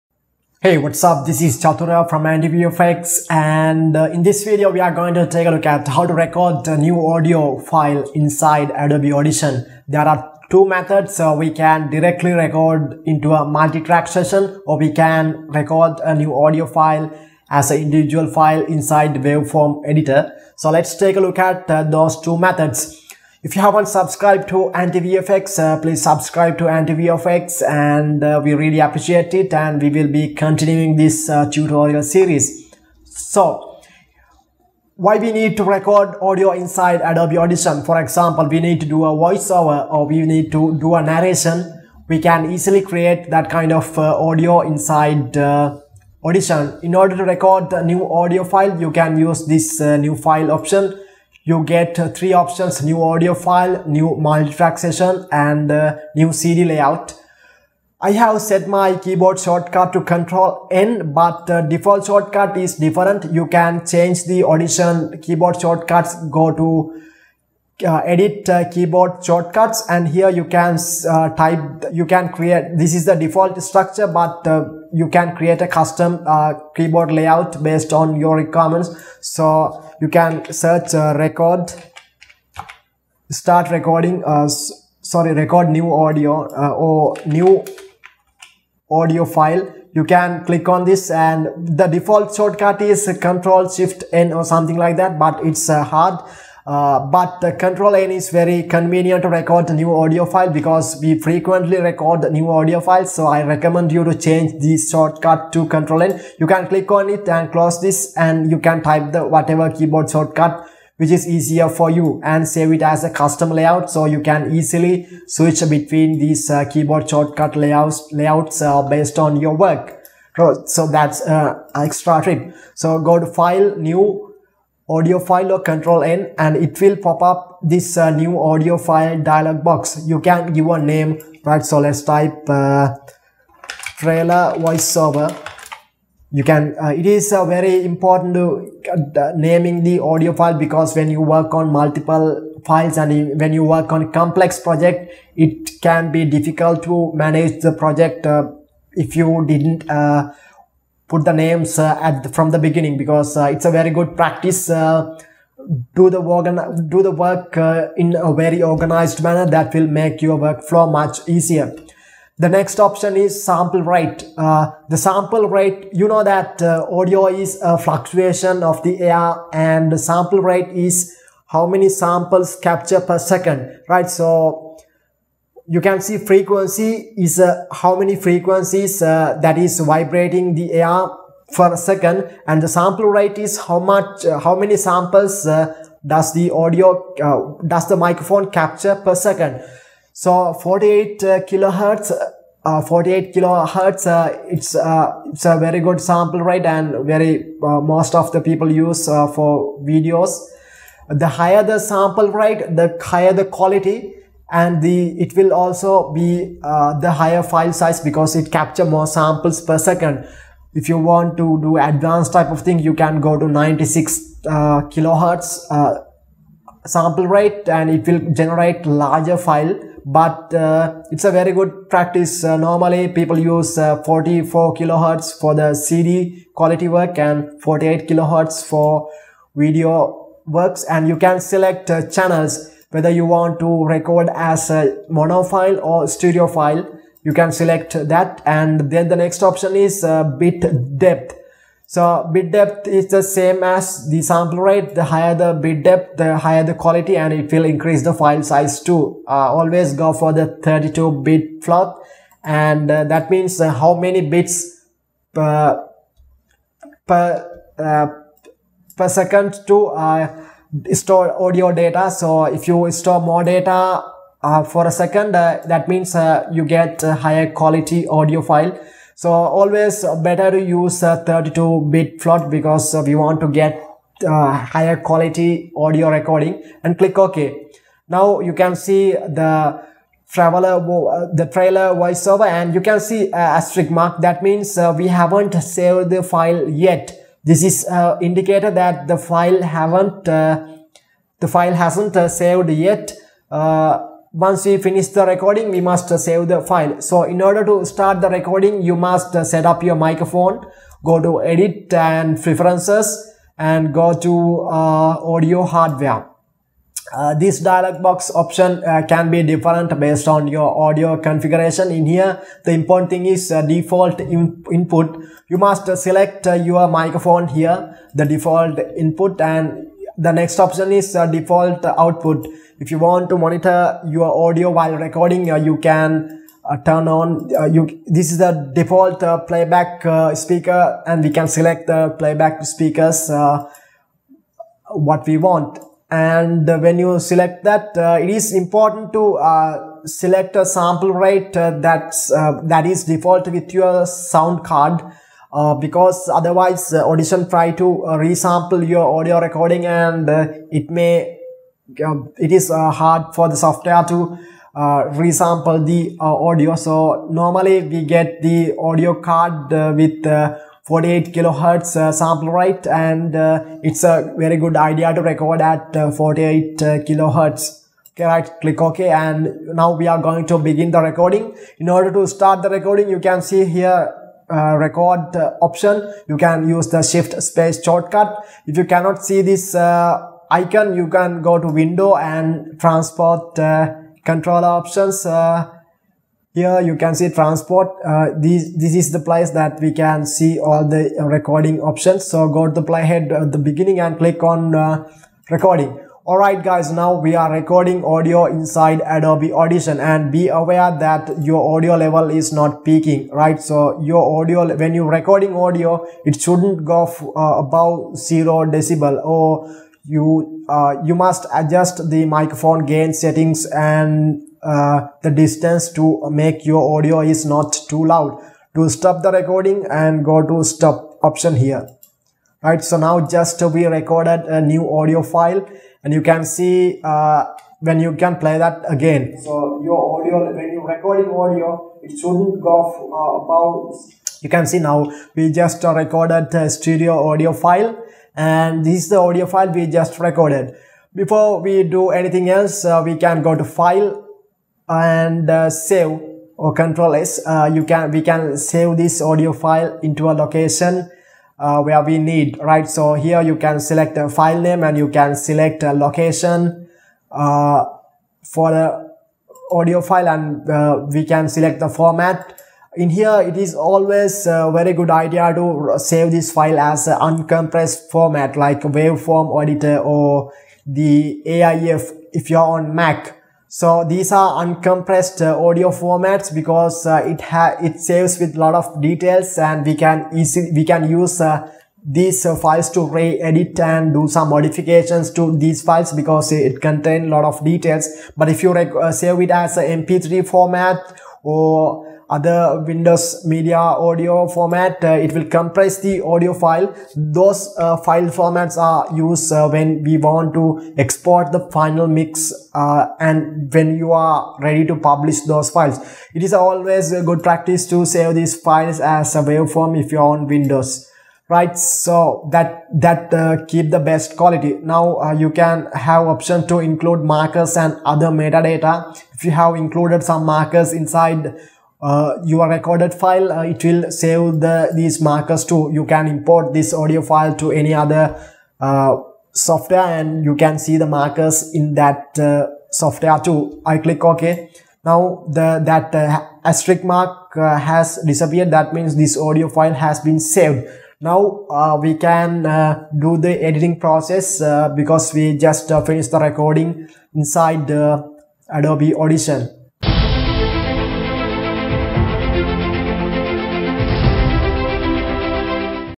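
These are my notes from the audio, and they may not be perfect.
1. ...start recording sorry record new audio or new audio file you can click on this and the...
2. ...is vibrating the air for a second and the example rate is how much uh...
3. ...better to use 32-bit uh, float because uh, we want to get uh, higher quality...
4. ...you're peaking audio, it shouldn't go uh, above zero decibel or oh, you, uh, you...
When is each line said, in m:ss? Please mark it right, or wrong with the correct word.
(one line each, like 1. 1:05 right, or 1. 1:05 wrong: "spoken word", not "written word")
1. 1:23 right
2. 2:59 wrong: "sample", not "example"
3. 4:30 right
4. 6:44 wrong: "recording", not "peaking".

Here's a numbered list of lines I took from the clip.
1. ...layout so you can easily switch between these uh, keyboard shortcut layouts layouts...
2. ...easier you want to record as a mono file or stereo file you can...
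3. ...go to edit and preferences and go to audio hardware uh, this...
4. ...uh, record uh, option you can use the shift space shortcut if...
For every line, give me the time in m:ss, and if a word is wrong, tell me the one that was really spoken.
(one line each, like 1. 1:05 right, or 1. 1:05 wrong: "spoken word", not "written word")
1. 1:53 right
2. 3:52 wrong: "whether", not "easier"
3. 5:01 right
4. 6:14 right.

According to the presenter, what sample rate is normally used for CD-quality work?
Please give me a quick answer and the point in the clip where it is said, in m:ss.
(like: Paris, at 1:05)
44 kHz, at 3:44.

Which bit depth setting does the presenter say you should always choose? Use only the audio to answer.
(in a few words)
32-bit float.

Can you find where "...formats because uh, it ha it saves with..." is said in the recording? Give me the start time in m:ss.
7:55.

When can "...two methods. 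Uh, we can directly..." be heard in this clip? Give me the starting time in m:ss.
0:10.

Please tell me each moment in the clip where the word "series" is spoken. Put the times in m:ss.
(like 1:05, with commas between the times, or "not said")
0:32.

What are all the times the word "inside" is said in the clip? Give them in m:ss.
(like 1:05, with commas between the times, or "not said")
0:08, 0:18, 0:36, 0:44, 6:38, 8:40, 9:07.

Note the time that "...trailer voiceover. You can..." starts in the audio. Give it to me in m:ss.
2:13.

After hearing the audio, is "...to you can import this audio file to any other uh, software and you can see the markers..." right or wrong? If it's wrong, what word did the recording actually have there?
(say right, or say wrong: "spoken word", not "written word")
right.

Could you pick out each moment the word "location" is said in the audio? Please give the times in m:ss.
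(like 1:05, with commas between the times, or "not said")
7:30, 7:35.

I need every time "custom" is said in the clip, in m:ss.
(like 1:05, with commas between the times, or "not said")
1:15, 1:53.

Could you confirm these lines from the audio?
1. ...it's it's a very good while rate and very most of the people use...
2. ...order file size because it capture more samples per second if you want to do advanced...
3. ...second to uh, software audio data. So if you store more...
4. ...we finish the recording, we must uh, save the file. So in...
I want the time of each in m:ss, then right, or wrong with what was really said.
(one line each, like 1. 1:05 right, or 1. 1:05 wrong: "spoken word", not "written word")
1. 3:14 wrong: "sample", not "while"
2. 3:27 wrong: "higher", not "order"
3. 4:19 wrong: "store", not "software"
4. 4:54 right.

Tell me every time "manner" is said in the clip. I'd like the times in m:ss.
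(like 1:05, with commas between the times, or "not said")
2:39.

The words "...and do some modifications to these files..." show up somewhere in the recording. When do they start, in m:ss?
8:03.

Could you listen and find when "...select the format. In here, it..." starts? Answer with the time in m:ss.
7:41.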